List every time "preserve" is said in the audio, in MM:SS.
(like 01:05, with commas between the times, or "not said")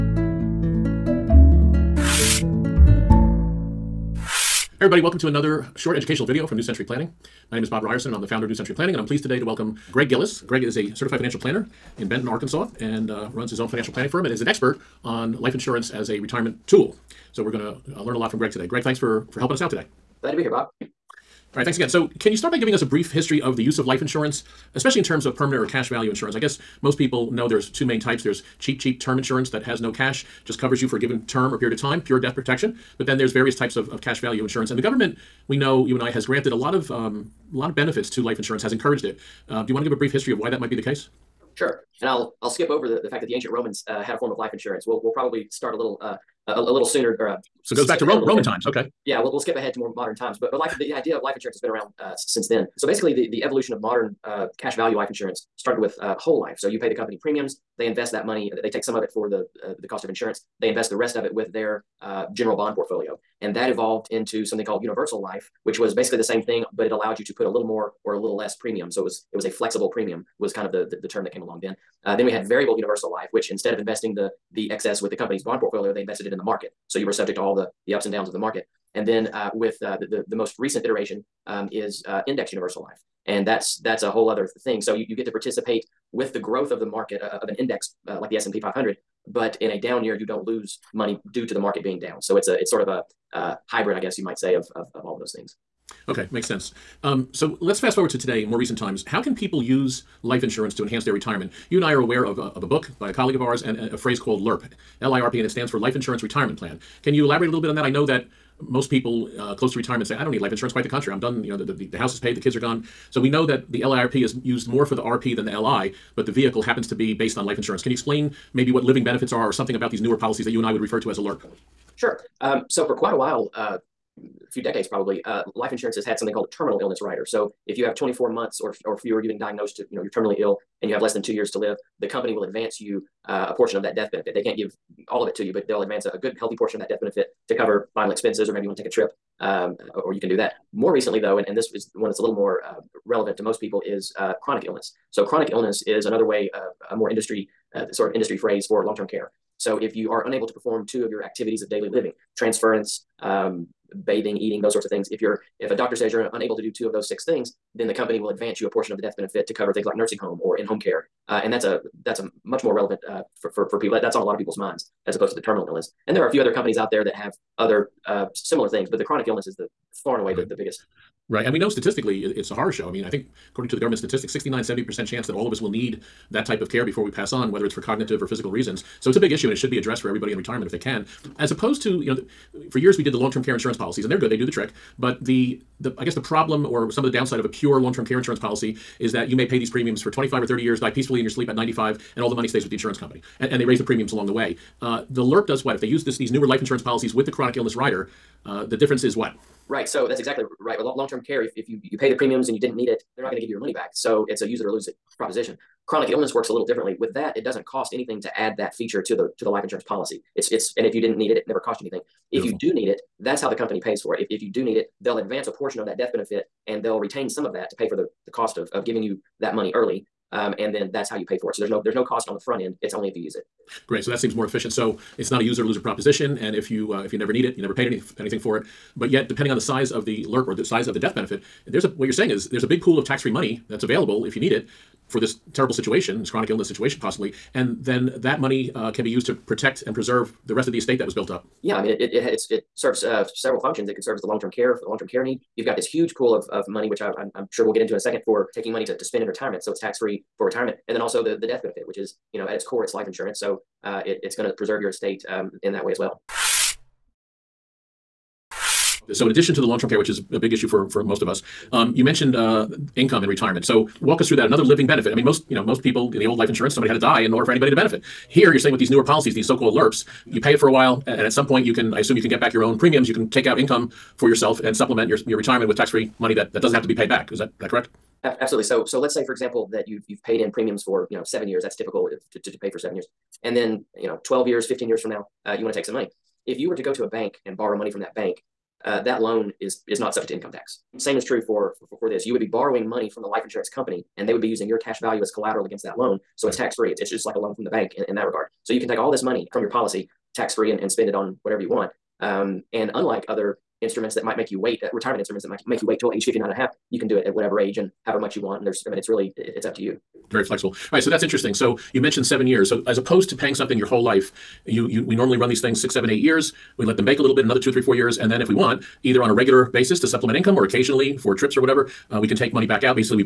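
03:59, 04:14.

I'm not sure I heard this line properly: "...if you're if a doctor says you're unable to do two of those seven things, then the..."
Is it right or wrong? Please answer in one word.
wrong.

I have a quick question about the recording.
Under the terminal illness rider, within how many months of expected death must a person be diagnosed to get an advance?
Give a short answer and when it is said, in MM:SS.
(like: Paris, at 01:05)
24, at 02:07.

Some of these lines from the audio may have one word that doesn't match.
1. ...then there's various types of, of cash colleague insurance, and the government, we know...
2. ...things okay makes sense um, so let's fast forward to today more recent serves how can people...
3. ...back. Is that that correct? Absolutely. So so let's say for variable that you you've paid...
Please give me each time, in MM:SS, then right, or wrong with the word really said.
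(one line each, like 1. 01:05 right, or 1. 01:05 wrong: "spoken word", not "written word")
1. 00:33 wrong: "value", not "colleague"
2. 01:35 wrong: "times", not "serves"
3. 04:37 wrong: "example", not "variable".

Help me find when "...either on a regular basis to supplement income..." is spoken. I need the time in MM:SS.
05:19.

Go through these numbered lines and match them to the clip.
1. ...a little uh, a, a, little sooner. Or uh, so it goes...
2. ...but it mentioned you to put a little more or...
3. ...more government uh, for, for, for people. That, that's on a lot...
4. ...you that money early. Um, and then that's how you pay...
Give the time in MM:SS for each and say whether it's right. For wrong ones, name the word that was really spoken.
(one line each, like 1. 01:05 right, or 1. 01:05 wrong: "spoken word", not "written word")
1. 00:45 right
2. 01:06 wrong: "allowed", not "mentioned"
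3. 02:42 wrong: "relevant", not "government"
4. 03:39 right.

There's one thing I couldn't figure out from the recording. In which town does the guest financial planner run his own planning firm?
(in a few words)
Benton, Arkansas.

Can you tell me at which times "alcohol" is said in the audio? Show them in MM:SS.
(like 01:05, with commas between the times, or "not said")
not said.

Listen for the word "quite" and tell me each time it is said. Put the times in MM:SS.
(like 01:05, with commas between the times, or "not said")
01:50, 02:02.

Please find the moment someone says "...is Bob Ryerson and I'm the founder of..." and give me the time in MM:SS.
00:07.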